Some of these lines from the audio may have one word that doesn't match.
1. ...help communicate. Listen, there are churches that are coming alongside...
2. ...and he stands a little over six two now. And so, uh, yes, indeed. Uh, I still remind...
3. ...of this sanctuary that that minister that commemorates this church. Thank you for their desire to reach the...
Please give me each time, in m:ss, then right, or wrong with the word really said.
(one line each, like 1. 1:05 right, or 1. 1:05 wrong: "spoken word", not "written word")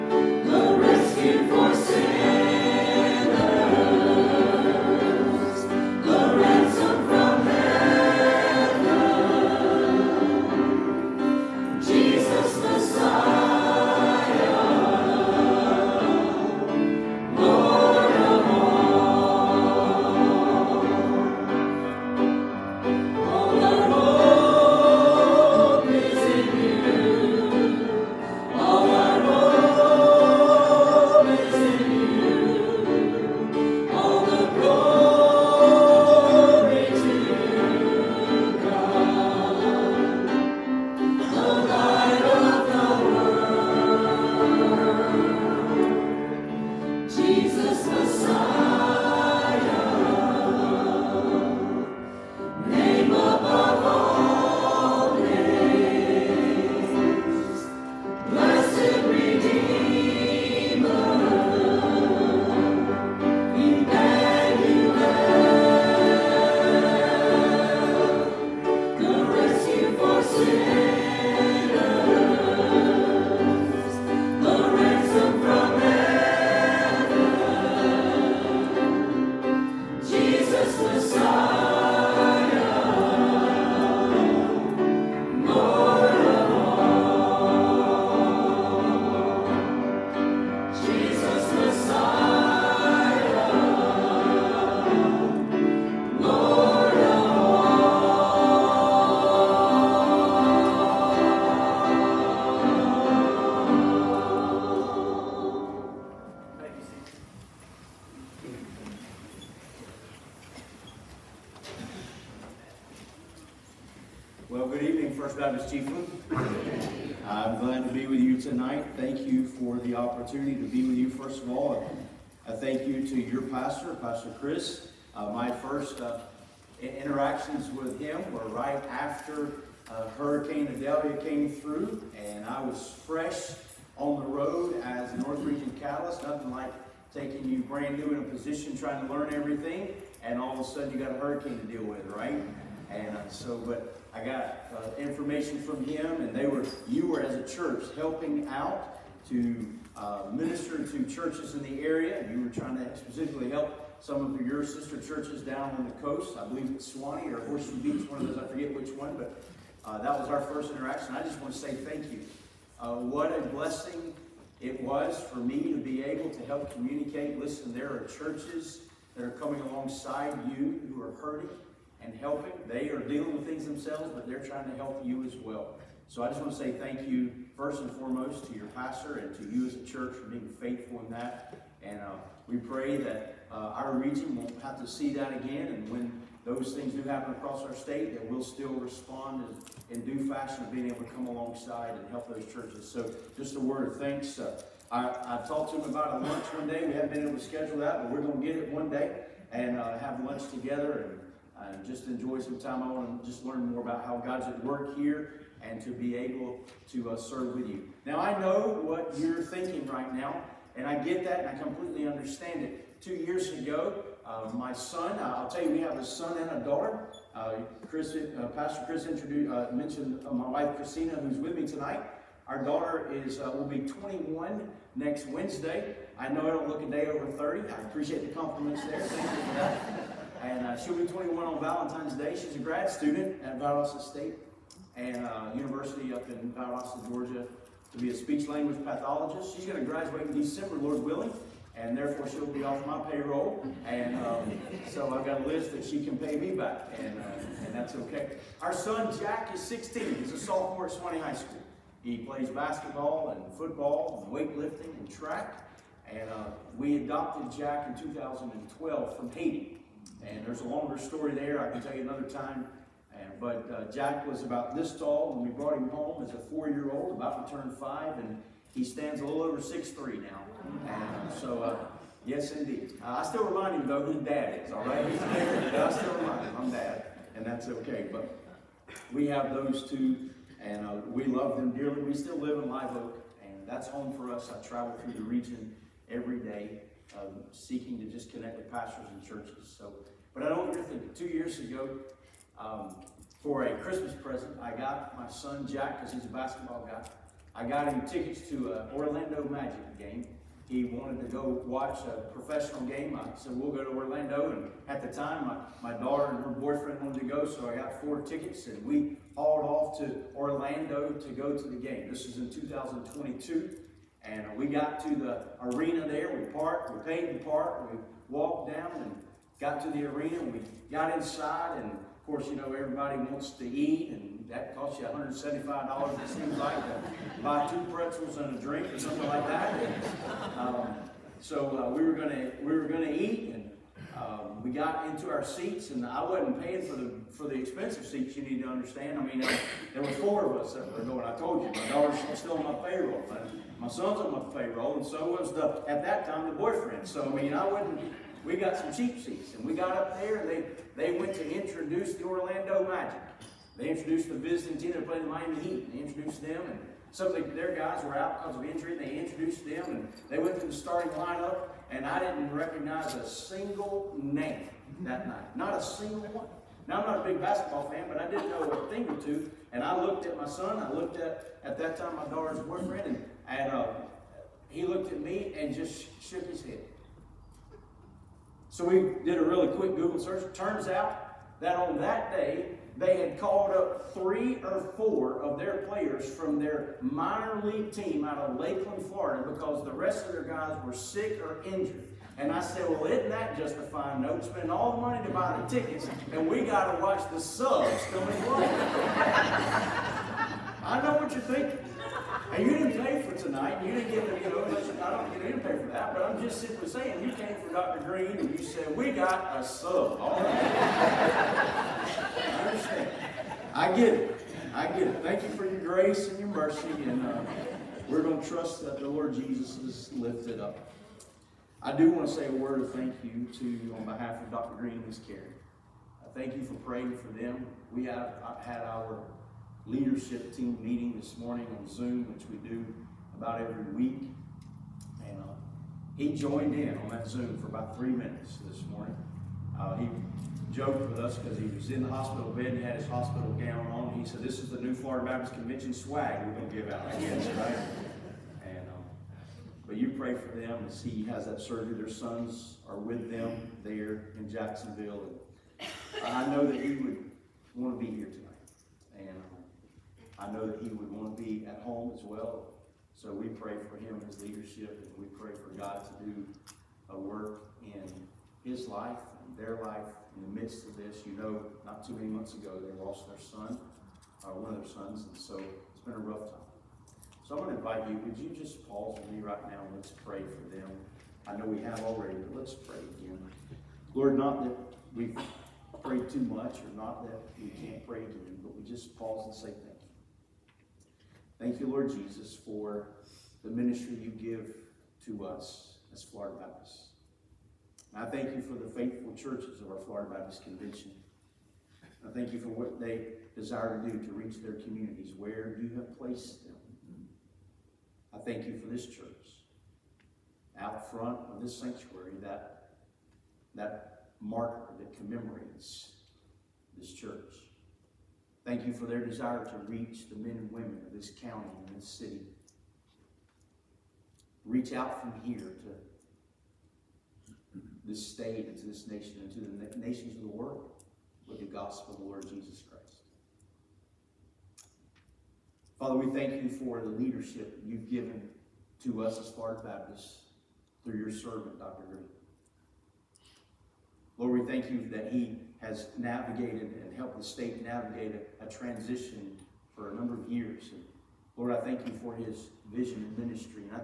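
1. 2:46 right
2. 4:28 wrong: "three", not "two"
3. 8:31 wrong: "marker", not "minister".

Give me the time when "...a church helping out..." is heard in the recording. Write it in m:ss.
2:27.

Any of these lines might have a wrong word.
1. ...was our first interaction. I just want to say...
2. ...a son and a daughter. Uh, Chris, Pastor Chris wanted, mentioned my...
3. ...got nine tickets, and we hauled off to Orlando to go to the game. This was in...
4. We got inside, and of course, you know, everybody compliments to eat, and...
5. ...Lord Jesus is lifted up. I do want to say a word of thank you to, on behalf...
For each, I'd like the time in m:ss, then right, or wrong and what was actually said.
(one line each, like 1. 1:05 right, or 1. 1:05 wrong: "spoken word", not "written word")
1. 2:40 right
2. 3:35 wrong: "introduced", not "wanted"
3. 5:07 wrong: "four", not "nine"
4. 5:20 wrong: "wants", not "compliments"
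5. 6:59 right.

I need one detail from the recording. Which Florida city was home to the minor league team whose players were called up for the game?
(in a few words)
Lakeland.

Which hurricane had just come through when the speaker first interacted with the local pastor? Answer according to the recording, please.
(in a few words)
Hurricane Idalia.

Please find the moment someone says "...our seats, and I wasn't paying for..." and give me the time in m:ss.
5:35.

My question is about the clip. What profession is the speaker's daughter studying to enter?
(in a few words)
speech language pathologist.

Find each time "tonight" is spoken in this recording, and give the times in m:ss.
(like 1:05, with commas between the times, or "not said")
1:58, 3:41, 6:43, 7:27, 7:38.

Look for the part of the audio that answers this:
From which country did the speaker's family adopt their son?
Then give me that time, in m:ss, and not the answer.
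4:19.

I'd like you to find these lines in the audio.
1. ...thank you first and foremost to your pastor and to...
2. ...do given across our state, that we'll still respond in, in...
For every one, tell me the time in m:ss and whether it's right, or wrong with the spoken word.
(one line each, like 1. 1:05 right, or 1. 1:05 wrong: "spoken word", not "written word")
1. 2:56 right
2. 3:06 wrong: "happen", not "given".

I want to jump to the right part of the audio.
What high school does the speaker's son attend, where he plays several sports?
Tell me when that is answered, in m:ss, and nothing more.
4:10.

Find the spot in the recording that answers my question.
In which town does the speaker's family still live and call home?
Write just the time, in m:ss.
4:42.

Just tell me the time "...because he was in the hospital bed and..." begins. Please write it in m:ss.
7:21.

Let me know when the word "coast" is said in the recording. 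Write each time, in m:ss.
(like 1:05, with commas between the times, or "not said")
2:36.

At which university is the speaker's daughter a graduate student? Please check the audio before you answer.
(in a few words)
Valdosta State.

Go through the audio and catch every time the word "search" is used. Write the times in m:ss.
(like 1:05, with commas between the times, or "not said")
6:20.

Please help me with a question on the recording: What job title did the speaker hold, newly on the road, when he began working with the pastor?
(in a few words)
North Region Catalyst.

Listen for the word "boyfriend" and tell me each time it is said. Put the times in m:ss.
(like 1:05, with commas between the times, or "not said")
5:06, 5:46, 6:12.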